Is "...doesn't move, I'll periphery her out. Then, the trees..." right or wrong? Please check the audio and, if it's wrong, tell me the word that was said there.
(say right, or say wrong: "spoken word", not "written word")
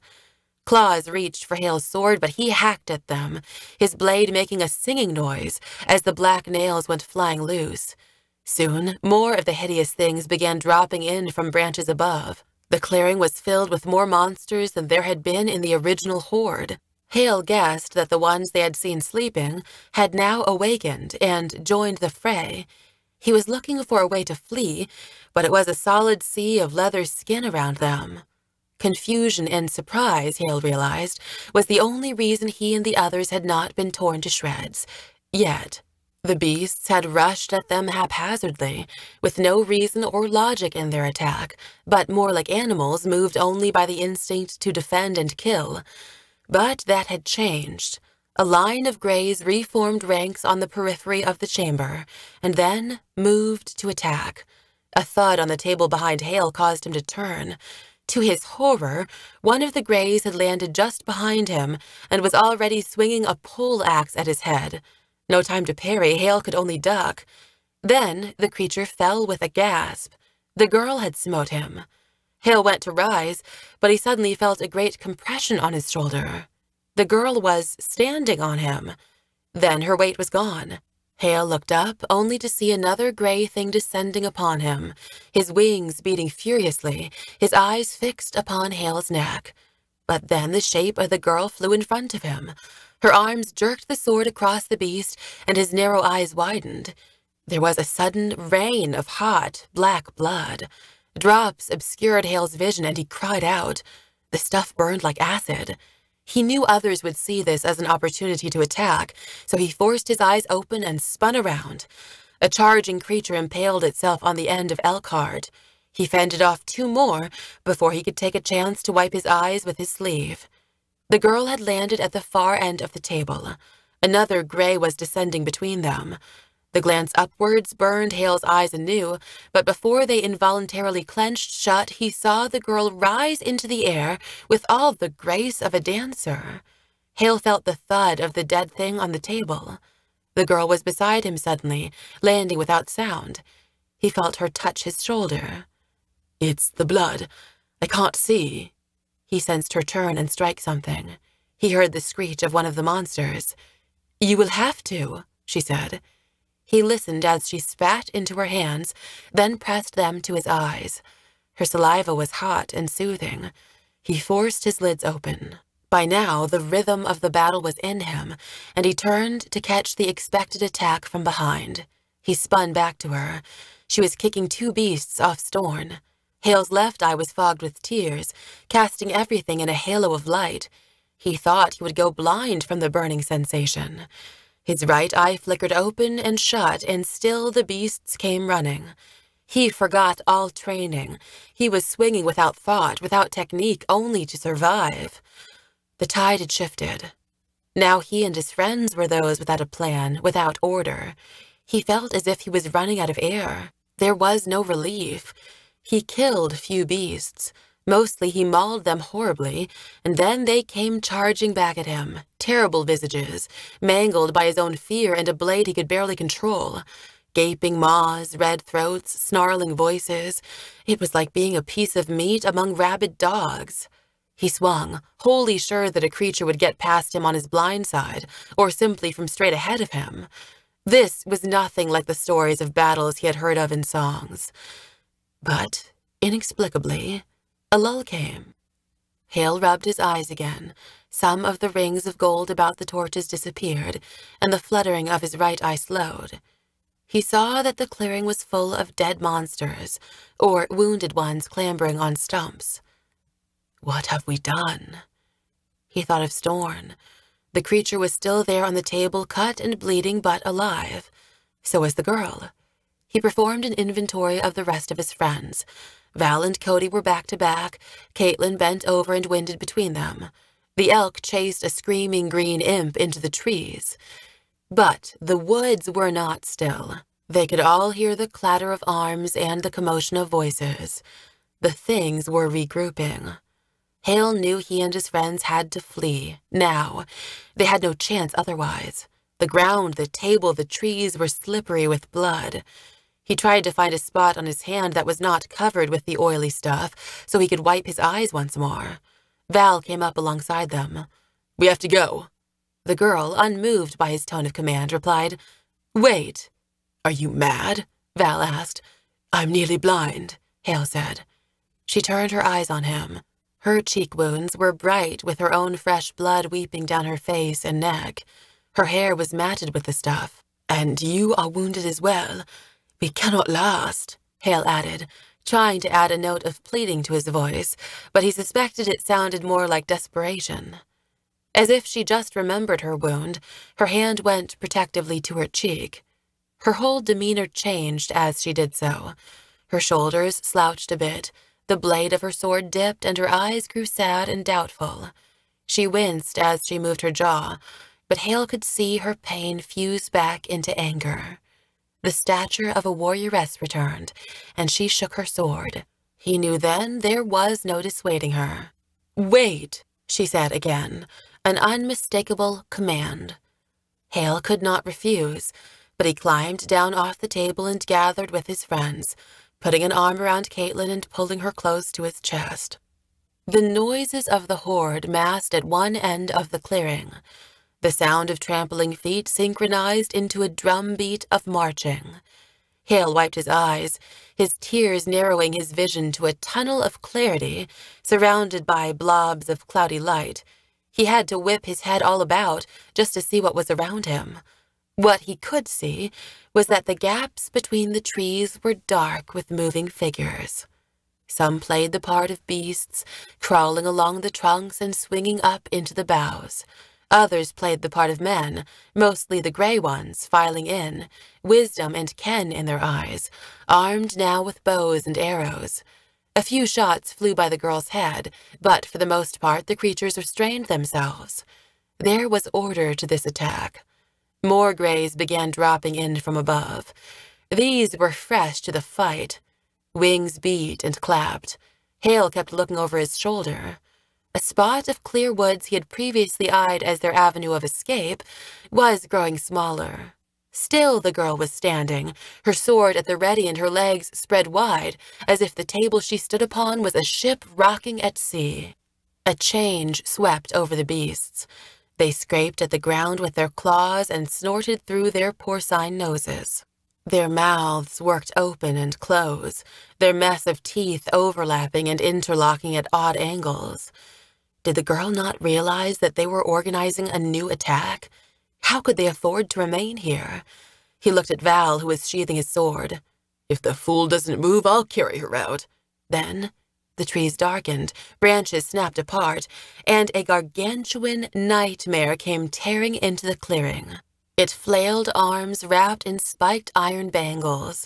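wrong: "carry", not "periphery".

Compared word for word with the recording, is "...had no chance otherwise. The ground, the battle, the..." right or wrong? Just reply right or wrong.
wrong.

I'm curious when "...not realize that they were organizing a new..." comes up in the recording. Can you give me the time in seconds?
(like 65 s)
465 s.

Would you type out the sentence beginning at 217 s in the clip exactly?
Gaping maws, red throats, snarling voices.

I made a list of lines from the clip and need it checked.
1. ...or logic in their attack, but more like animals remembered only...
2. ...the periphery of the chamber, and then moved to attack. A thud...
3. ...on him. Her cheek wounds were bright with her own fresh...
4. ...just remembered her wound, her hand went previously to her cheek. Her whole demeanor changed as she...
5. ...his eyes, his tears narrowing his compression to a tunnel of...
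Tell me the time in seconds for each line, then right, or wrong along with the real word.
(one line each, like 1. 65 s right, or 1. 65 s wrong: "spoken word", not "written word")
1. 40 s wrong: "moved", not "remembered"
2. 50 s right
3. 312 s right
4. 332 s wrong: "protectively", not "previously"
5. 383 s wrong: "vision", not "compression".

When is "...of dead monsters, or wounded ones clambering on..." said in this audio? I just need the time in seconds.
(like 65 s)
248 s.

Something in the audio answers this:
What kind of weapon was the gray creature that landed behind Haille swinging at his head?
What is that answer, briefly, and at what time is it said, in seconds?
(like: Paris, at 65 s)
a pole axe, at 63 s.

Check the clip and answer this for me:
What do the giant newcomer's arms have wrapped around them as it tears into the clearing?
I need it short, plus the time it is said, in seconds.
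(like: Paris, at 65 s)
spiked iron bangles, at 486 s.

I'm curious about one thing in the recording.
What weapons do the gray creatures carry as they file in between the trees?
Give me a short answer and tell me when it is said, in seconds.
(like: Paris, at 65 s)
bows and arrows, at 414 s.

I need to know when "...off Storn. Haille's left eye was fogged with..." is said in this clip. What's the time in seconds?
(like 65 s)
175 s.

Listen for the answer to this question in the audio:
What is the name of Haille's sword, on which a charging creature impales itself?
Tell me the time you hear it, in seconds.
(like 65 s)
114 s.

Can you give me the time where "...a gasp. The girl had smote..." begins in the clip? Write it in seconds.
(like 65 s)
69 s.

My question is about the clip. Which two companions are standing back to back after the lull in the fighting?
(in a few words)
Val and Cody.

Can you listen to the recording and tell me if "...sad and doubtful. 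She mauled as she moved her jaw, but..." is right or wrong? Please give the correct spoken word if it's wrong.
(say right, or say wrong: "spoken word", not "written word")
wrong: "winced", not "mauled".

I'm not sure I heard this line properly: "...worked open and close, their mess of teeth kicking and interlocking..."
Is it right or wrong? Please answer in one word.
wrong.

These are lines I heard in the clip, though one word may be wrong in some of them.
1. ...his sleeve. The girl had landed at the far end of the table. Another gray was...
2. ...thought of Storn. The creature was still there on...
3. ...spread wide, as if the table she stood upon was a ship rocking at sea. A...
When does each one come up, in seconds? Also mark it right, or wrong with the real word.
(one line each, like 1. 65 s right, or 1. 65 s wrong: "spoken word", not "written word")
1. 119 s right
2. 256 s right
3. 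444 s right.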